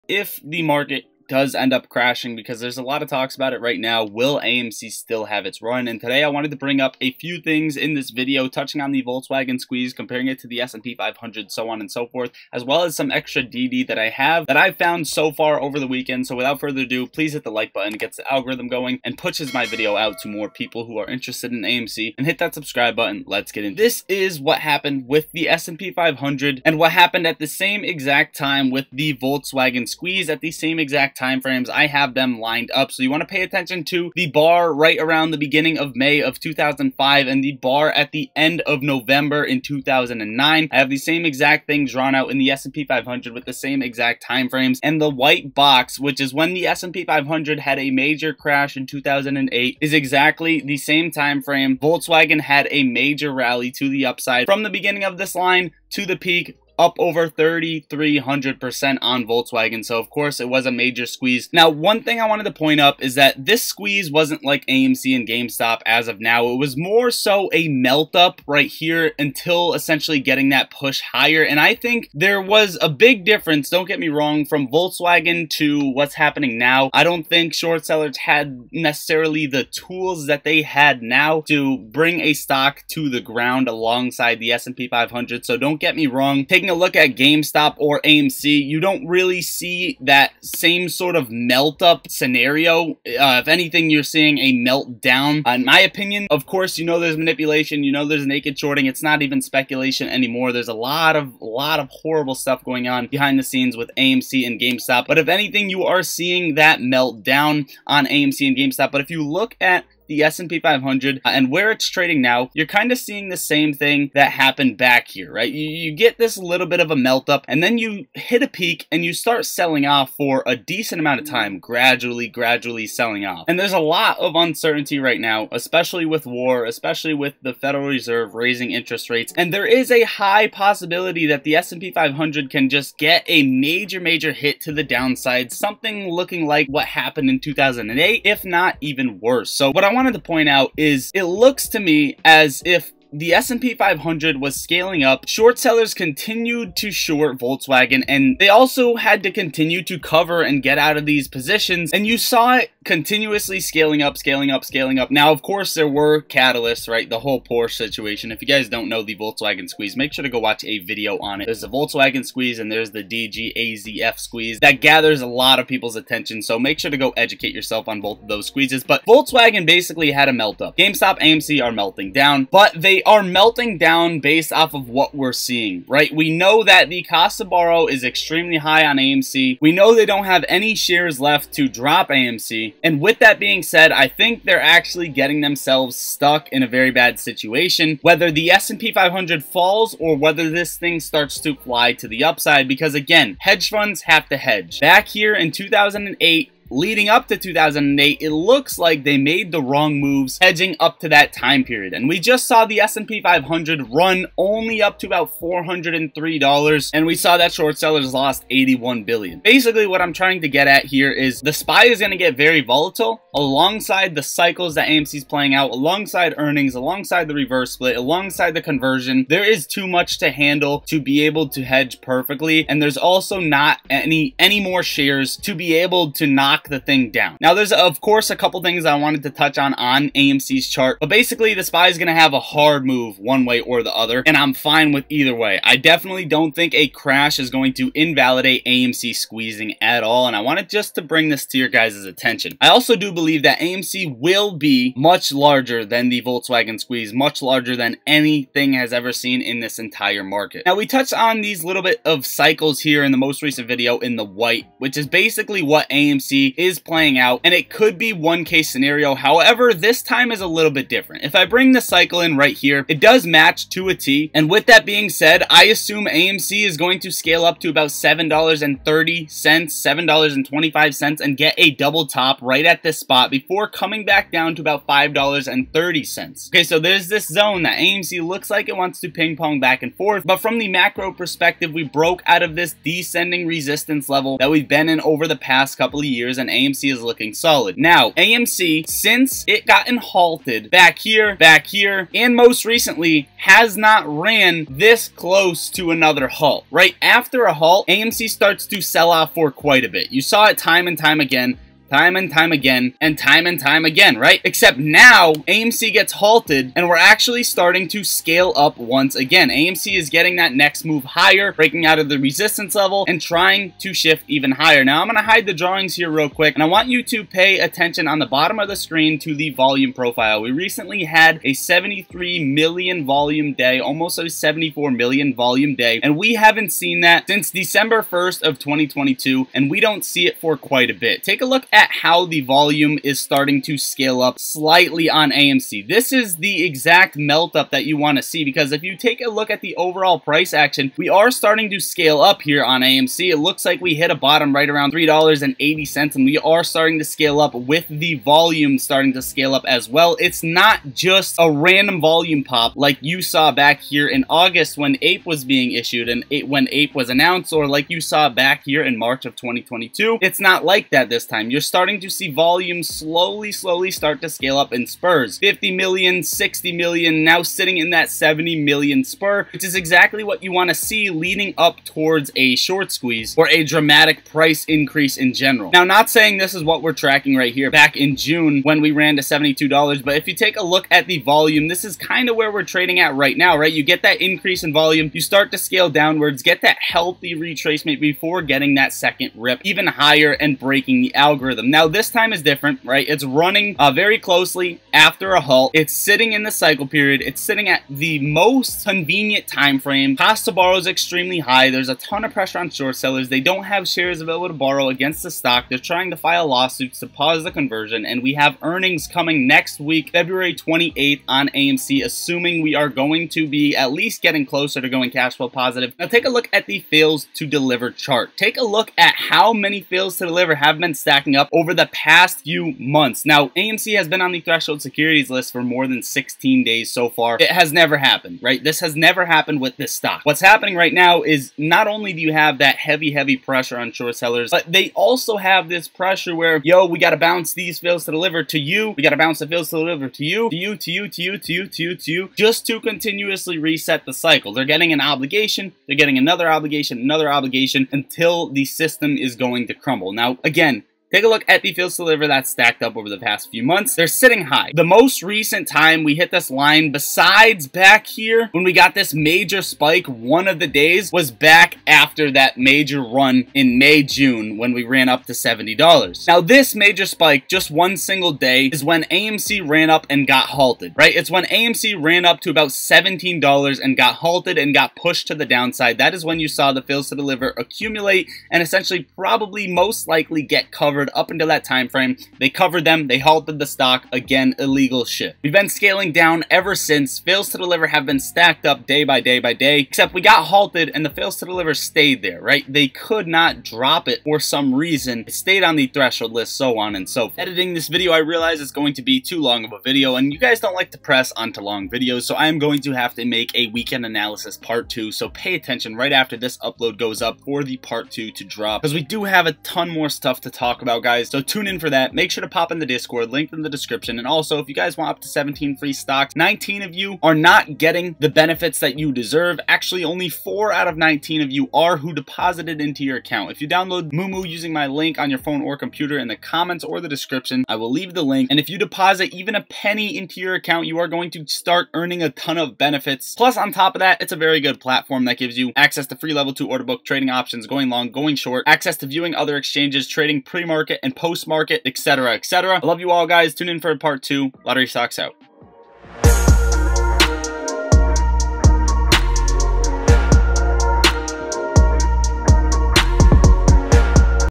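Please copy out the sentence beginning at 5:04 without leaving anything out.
Except now AMC gets halted and we're actually starting to scale up once again.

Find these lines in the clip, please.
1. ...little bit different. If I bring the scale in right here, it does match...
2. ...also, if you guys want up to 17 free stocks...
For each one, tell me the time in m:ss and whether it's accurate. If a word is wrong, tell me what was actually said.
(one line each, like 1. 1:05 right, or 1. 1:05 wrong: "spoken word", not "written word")
1. 4:20 wrong: "cycle", not "scale"
2. 8:34 right.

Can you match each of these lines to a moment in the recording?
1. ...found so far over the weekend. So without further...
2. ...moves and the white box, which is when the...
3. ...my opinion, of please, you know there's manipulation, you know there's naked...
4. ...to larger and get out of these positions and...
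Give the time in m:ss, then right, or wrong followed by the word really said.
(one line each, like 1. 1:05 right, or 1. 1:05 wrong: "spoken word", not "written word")
1. 0:14 right
2. 0:44 wrong: "frames", not "moves"
3. 1:35 wrong: "course", not "please"
4. 2:29 wrong: "cover", not "larger".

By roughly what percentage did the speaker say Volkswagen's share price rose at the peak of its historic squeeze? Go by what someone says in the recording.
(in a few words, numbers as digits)
3,300%.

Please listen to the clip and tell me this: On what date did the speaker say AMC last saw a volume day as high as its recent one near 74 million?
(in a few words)
December 1st, 2022.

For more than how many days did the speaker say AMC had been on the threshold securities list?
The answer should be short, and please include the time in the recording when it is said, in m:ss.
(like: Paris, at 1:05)
16 days, at 7:06.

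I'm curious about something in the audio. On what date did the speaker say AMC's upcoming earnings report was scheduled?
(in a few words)
February 28th.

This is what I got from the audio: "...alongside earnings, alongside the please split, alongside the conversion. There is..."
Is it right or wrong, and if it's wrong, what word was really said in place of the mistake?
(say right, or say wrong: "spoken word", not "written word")
wrong: "reverse", not "please".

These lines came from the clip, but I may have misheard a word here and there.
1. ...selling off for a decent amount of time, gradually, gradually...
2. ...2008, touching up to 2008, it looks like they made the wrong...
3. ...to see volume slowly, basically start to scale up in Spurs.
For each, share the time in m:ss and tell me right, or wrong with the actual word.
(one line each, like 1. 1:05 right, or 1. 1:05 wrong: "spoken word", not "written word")
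1. 1:59 right
2. 3:15 wrong: "leading", not "touching"
3. 6:02 wrong: "slowly", not "basically".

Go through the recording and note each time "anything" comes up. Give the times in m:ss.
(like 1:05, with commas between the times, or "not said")
1:33, 1:45, 4:08.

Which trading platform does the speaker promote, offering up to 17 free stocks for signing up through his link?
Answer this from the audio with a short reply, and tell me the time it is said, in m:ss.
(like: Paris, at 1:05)
Moomoo, at 8:44.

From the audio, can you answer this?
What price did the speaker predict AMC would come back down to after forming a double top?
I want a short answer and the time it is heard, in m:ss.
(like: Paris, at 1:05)
$5.30, at 4:34.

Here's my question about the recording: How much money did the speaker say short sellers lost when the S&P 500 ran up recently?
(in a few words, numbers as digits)
81 billion.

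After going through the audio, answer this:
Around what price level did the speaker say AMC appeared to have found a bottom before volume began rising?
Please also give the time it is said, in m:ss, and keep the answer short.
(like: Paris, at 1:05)
$3.80, at 5:44.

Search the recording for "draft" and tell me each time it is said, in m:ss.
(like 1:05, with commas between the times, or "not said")
not said.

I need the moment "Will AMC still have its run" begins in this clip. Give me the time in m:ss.
0:04.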